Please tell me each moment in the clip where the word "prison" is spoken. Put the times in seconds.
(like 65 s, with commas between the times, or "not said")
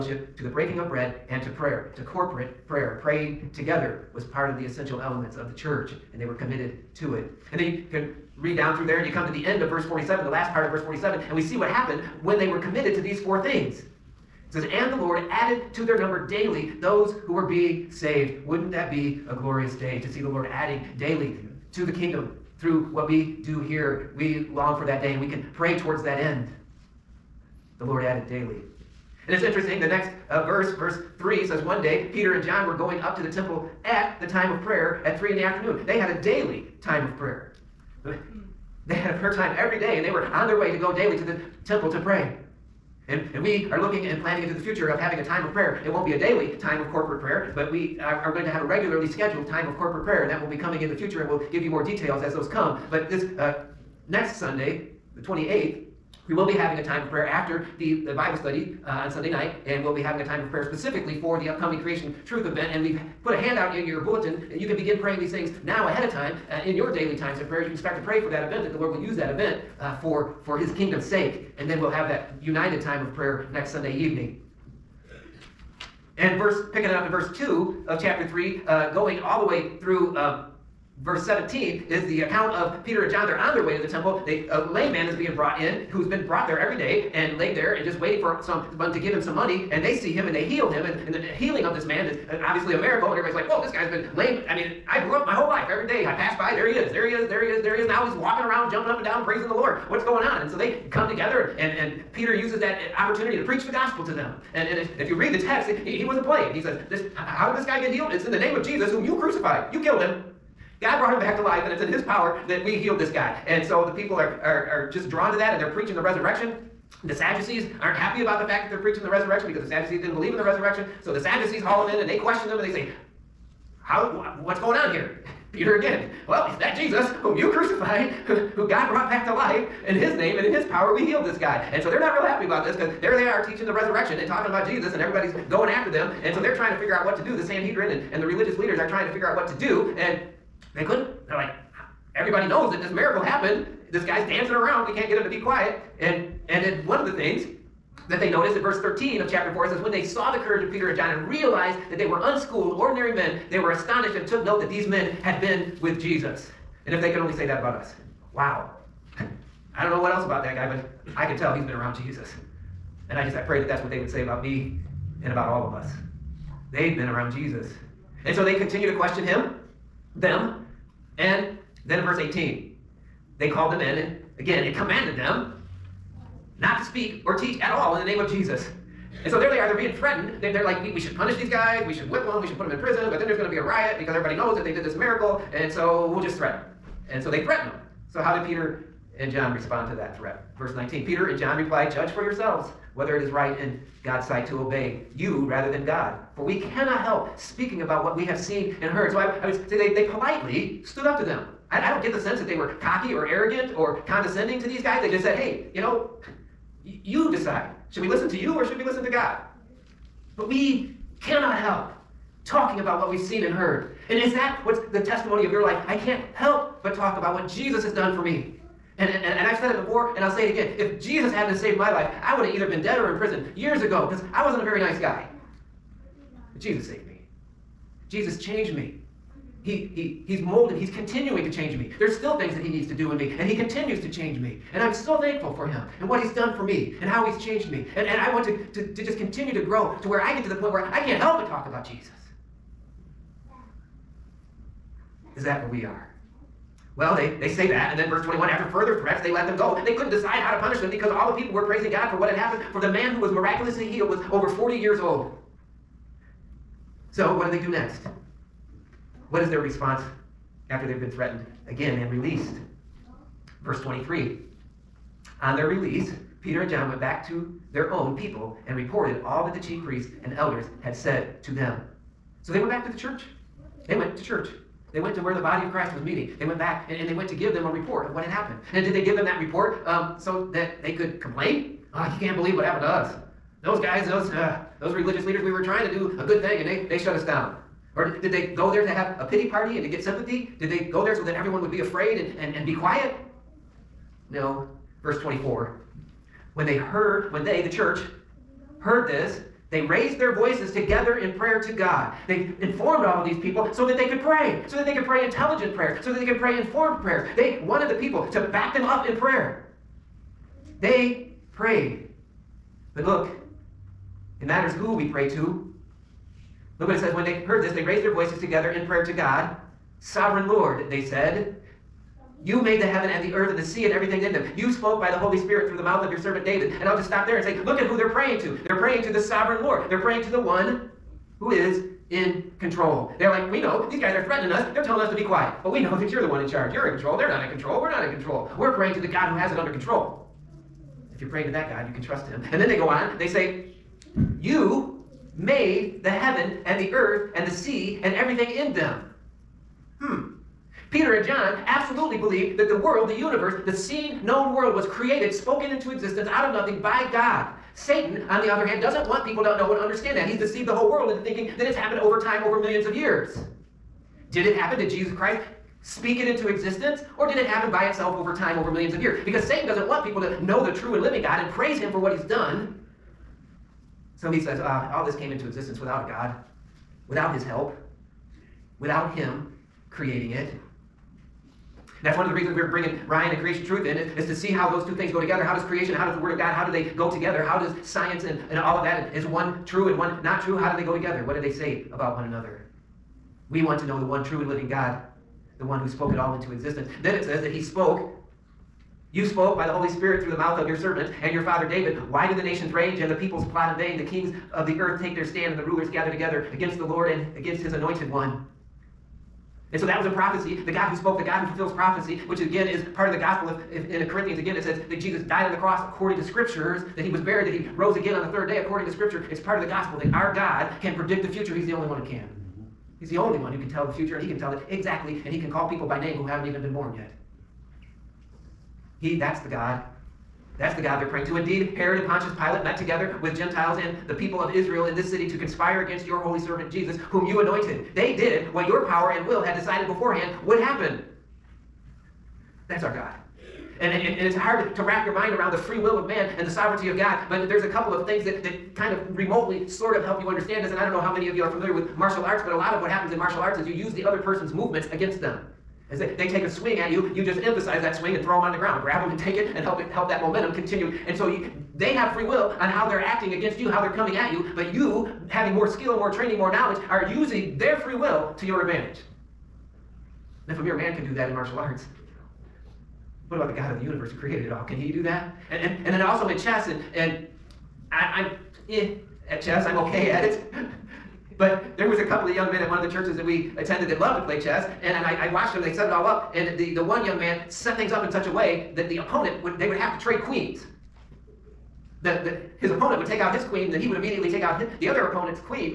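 182 s, 223 s.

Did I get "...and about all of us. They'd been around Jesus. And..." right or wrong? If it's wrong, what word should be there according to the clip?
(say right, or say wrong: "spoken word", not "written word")
right.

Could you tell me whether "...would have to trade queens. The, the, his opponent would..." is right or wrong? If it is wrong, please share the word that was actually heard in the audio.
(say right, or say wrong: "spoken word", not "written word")
right.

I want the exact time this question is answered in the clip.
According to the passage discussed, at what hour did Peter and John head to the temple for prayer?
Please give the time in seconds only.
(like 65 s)
35 s.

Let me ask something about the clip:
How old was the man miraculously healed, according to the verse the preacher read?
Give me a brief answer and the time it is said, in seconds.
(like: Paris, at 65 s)
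over 40, at 254 s.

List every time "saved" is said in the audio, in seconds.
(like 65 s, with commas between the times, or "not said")
17 s, 221 s, 226 s.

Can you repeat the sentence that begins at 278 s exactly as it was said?
And did they give them that report um, so that they could complain?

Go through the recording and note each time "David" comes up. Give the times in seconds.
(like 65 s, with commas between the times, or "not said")
326 s, 401 s.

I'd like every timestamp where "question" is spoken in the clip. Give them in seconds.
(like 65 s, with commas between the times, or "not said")
122 s, 168 s.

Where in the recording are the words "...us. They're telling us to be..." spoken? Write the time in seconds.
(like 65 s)
334 s.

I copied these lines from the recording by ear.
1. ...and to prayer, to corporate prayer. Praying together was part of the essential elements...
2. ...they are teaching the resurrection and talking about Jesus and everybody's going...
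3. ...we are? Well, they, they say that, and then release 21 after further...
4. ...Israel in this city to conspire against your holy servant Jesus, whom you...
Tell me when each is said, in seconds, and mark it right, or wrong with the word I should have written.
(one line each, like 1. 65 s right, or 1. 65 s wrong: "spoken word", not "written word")
1. 1 s right
2. 133 s right
3. 245 s wrong: "verse", not "release"
4. 434 s right.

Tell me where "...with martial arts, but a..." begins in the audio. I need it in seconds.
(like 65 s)
451 s.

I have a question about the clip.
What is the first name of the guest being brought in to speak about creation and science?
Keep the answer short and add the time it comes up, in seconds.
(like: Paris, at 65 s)
Ryan, at 382 s.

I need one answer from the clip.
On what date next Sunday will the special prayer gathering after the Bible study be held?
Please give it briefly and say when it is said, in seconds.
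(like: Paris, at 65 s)
28th, at 55 s.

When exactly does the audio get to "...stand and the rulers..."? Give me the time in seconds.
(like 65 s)
405 s.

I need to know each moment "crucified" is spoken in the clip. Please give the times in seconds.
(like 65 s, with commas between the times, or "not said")
109 s, 127 s.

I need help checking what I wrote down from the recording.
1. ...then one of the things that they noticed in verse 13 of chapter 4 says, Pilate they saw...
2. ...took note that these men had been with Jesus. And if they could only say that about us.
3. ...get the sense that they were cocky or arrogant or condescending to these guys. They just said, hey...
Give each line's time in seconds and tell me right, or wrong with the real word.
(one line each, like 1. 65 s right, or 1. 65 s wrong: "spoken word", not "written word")
1. 146 s wrong: "When", not "Pilate"
2. 154 s right
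3. 202 s right.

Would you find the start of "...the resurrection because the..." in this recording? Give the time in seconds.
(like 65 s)
119 s.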